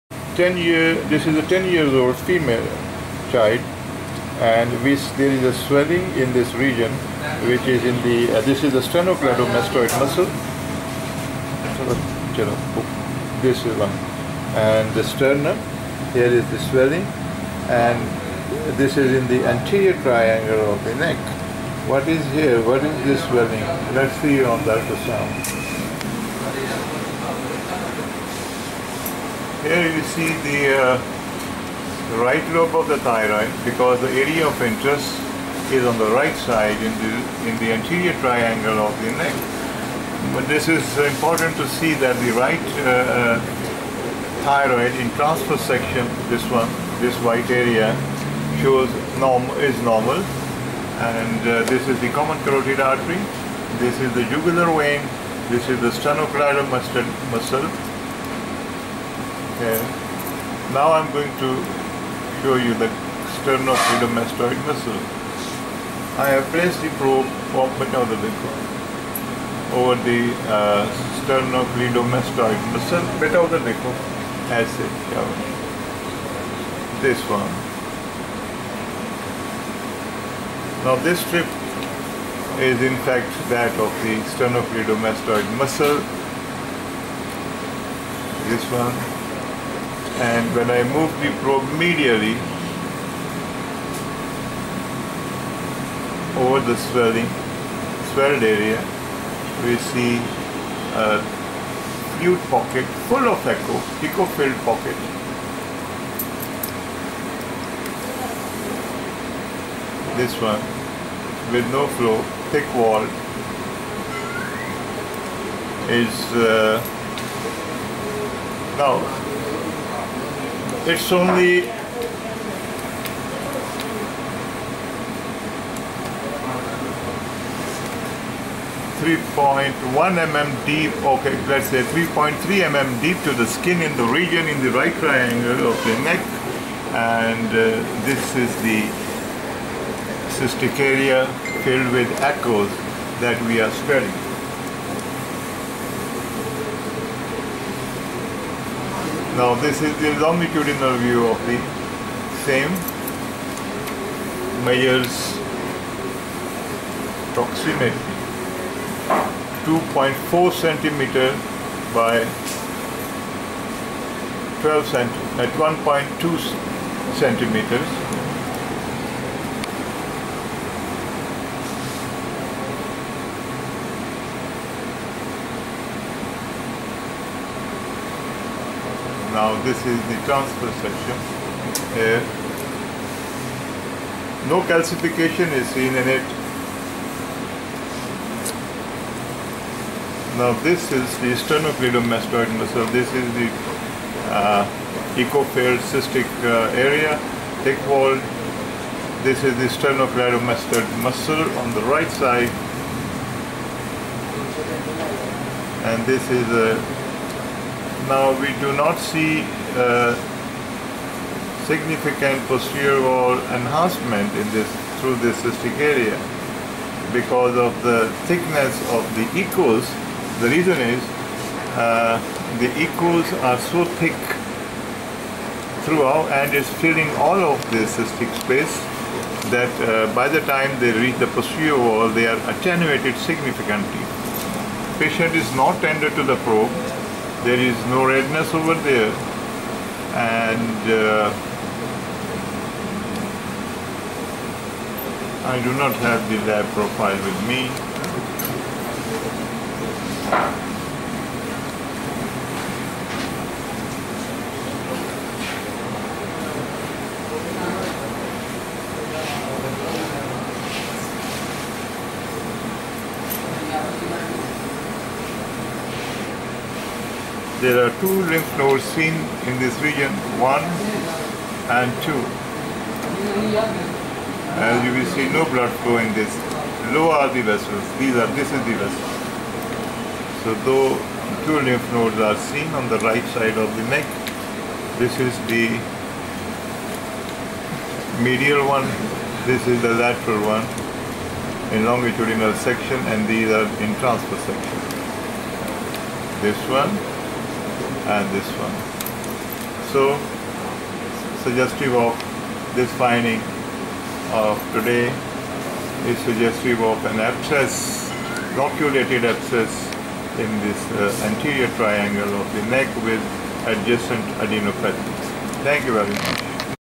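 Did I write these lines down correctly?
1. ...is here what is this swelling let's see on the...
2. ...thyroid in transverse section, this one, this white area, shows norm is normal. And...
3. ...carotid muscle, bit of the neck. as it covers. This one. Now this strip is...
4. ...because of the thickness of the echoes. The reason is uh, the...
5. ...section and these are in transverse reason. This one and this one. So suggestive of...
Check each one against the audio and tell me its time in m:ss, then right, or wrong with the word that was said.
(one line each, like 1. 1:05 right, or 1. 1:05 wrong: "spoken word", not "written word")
1. 0:22 right
2. 0:44 right
3. 1:11 wrong: "sternocleidomastoid", not "carotid"
4. 3:37 right
5. 4:52 wrong: "section", not "reason".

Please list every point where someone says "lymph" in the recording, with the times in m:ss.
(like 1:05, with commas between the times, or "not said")
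4:28, 4:41.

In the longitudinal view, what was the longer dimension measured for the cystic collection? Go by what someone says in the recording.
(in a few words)
2.4 centimeters.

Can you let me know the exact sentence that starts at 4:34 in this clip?
As you will see, no blood flow in this.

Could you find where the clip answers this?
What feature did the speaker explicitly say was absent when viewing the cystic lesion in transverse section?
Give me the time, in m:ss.
3:04.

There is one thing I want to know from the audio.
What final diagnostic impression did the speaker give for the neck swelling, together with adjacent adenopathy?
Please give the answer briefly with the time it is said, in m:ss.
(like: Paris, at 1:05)
loculated abscess, at 5:08.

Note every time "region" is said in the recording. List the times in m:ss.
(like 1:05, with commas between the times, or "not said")
0:06, 2:14, 4:29.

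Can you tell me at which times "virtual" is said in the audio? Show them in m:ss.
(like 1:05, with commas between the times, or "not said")
not said.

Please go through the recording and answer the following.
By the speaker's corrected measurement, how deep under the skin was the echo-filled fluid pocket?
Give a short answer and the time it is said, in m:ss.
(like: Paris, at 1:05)
3.3 mm, at 2:11.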